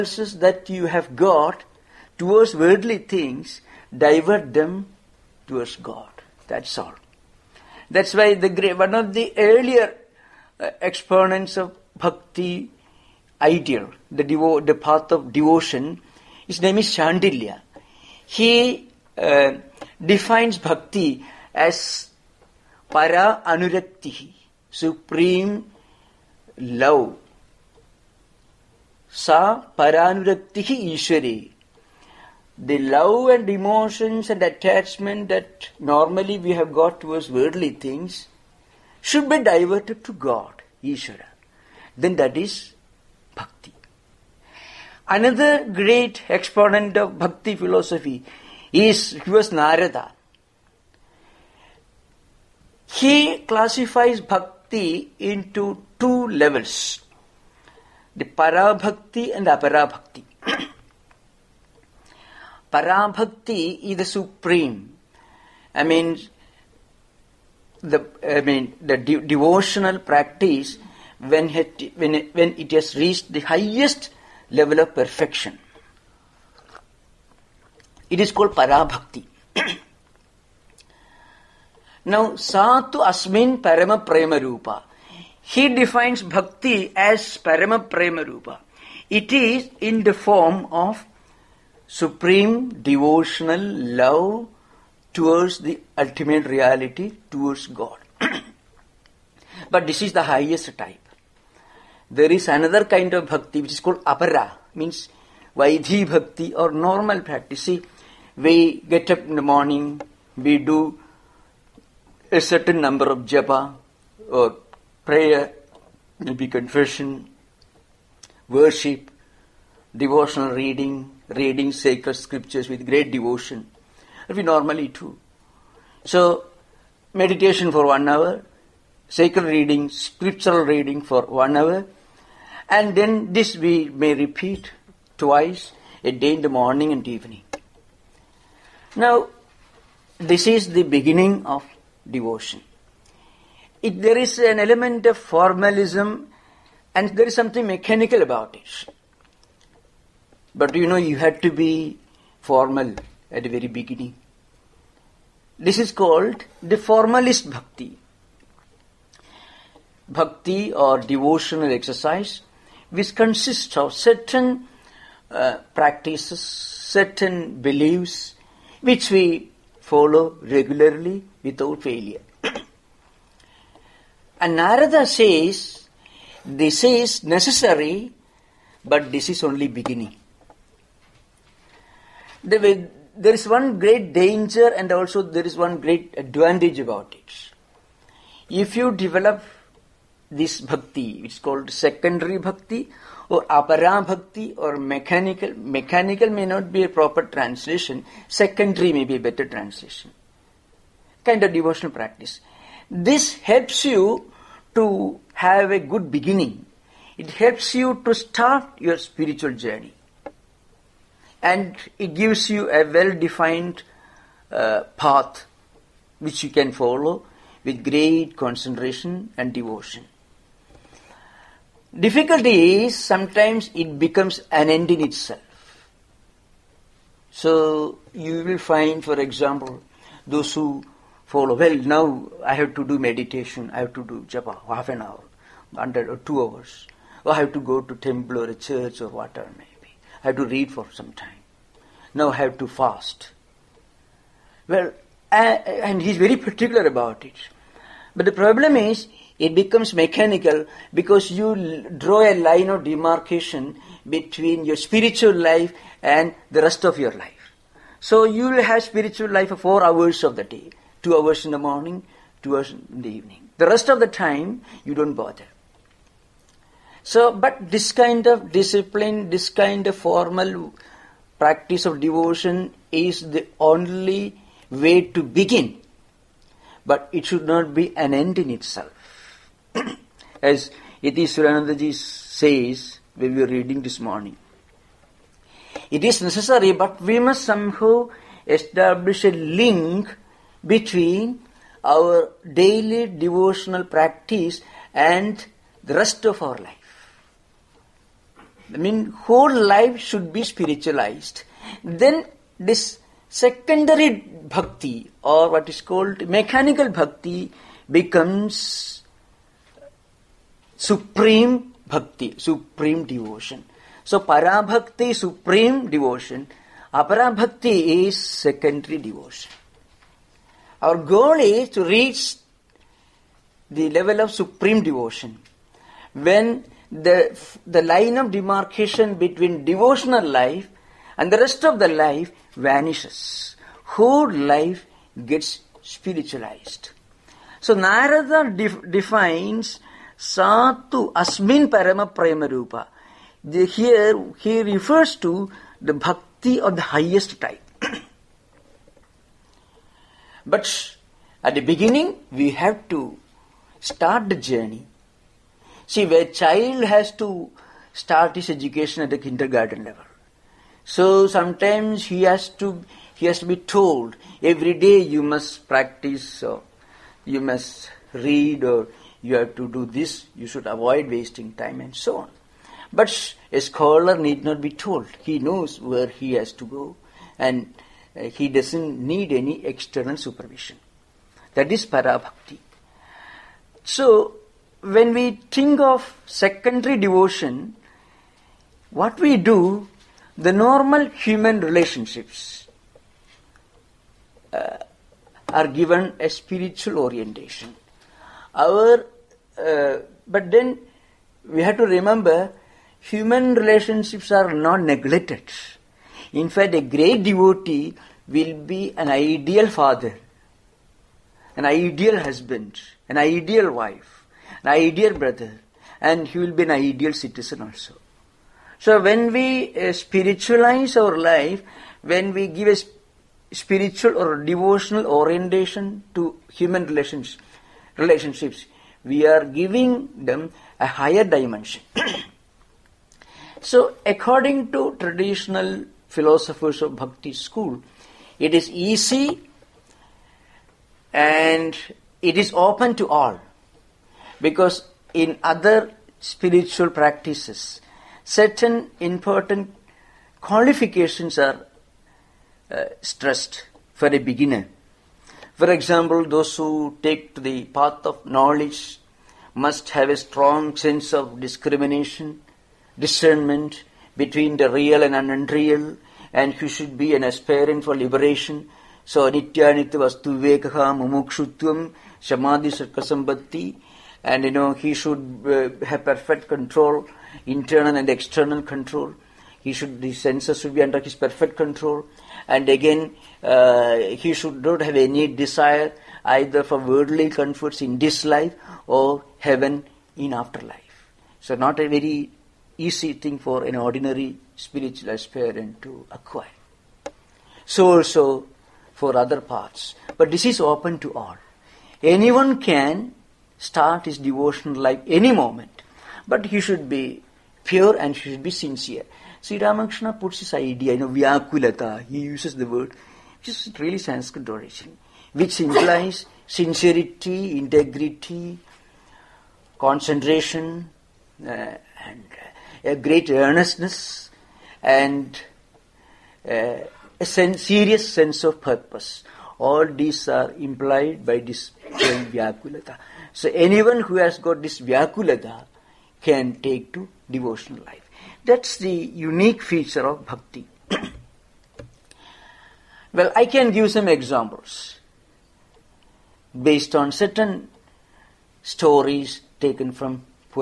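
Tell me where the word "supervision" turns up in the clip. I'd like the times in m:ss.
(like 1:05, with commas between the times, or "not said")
6:20.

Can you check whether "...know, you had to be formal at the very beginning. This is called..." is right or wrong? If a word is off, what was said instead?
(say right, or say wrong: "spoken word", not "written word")
right.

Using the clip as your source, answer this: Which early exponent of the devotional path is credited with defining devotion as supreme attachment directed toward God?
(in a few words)
Shandilya.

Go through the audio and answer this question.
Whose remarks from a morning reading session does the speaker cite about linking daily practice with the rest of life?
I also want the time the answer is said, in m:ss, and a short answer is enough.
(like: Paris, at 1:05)
Iti Suranandaji, at 4:41.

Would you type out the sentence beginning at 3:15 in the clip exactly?
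Mechanical may not be a proper translation.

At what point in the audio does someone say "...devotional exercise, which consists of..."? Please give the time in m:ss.
2:40.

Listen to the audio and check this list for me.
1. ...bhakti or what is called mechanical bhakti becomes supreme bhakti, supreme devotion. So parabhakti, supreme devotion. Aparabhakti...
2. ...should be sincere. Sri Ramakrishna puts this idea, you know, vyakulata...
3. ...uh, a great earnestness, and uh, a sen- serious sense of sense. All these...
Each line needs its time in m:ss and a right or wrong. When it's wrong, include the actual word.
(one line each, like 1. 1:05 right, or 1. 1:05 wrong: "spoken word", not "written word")
1. 5:04 right
2. 8:28 right
3. 8:42 wrong: "purpose", not "sense".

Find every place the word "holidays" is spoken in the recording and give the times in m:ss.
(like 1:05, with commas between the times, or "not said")
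not said.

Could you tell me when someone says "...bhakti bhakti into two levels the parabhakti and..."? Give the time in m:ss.
0:54.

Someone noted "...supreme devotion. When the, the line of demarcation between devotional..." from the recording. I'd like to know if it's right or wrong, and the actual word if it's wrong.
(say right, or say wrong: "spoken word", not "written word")
right.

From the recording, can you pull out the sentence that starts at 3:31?
And it gives you a well defined uh, path which you can follow with great concentration and devotion.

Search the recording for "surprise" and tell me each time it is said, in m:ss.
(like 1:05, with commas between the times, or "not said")
not said.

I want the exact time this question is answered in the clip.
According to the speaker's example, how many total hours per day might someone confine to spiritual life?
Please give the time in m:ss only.
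4:19.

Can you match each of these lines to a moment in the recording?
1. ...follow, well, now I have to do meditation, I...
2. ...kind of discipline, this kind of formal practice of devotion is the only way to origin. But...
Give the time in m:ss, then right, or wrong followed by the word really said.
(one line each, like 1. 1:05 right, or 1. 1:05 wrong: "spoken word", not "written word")
1. 3:51 right
2. 4:27 wrong: "begin", not "origin".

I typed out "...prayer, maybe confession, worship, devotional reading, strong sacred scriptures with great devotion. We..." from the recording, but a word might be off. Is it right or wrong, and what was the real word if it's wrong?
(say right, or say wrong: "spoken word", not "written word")
wrong: "reading", not "strong".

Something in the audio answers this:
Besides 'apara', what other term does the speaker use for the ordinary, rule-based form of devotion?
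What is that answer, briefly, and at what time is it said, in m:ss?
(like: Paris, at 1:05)
vaidhi bhakti, at 1:45.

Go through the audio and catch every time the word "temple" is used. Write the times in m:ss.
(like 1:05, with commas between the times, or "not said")
3:57.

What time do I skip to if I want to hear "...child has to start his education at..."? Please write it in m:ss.
5:56.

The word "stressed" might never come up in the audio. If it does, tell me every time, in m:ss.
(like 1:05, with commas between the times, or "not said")
7:33.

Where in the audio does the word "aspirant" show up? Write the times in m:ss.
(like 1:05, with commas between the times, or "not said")
7:47, 8:15.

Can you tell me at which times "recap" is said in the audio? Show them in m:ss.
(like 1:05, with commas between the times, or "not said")
not said.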